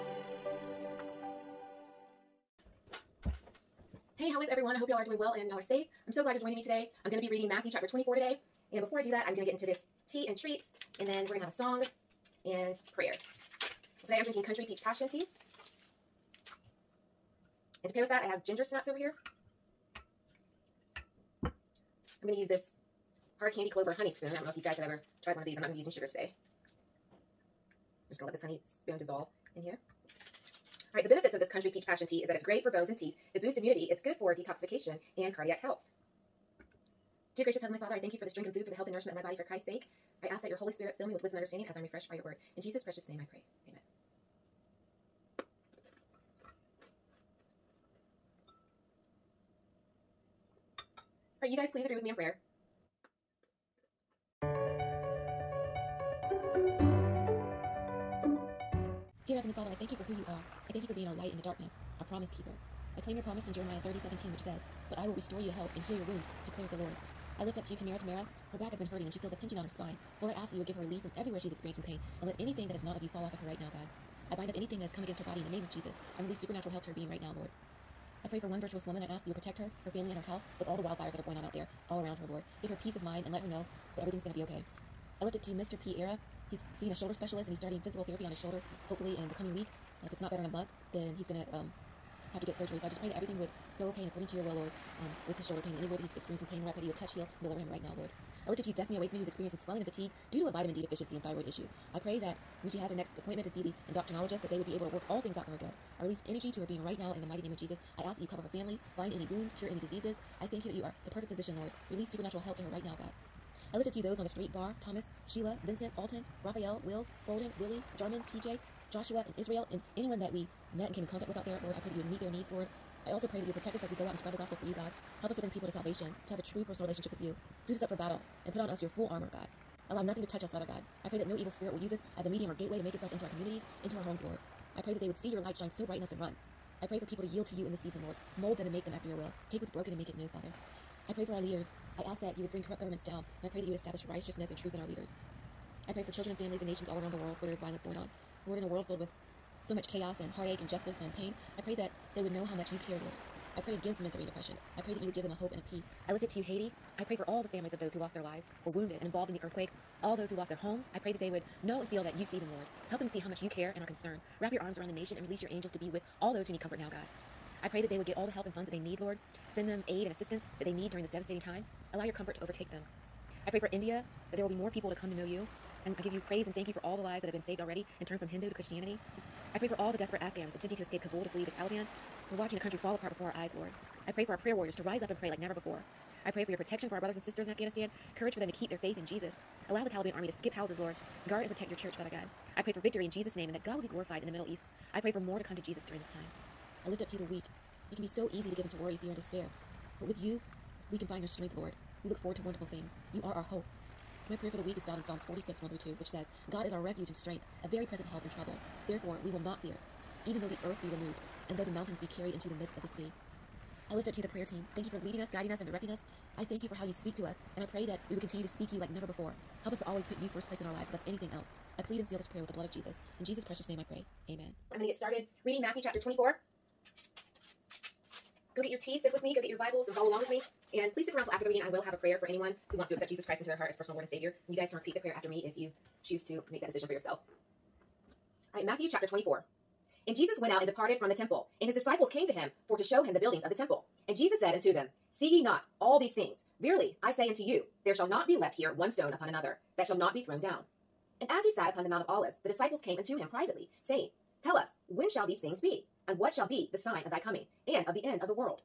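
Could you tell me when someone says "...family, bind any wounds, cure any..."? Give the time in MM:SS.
01:48.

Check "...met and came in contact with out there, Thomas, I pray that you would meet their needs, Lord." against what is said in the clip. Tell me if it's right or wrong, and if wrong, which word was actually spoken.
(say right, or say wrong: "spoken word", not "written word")
wrong: "Lord", not "Thomas".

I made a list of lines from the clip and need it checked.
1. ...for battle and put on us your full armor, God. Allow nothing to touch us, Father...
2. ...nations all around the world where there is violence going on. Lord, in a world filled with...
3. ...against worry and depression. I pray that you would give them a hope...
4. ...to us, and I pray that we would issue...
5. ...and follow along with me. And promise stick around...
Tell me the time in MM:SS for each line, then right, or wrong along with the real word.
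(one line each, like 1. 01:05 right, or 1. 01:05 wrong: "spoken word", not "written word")
1. 02:07 right
2. 02:26 right
3. 02:33 wrong: "misery", not "worry"
4. 03:37 wrong: "continue", not "issue"
5. 03:49 wrong: "please", not "promise".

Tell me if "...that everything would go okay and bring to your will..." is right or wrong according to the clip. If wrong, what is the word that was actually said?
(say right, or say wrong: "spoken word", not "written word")
wrong: "according", not "bring".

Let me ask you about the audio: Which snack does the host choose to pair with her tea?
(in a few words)
Ginger snaps.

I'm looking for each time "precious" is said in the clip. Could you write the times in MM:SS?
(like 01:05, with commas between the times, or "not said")
00:42, 03:43.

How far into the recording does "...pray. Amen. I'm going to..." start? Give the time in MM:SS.
03:43.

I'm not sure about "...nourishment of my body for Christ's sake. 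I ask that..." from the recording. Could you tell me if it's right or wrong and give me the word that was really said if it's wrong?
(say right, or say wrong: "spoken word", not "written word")
right.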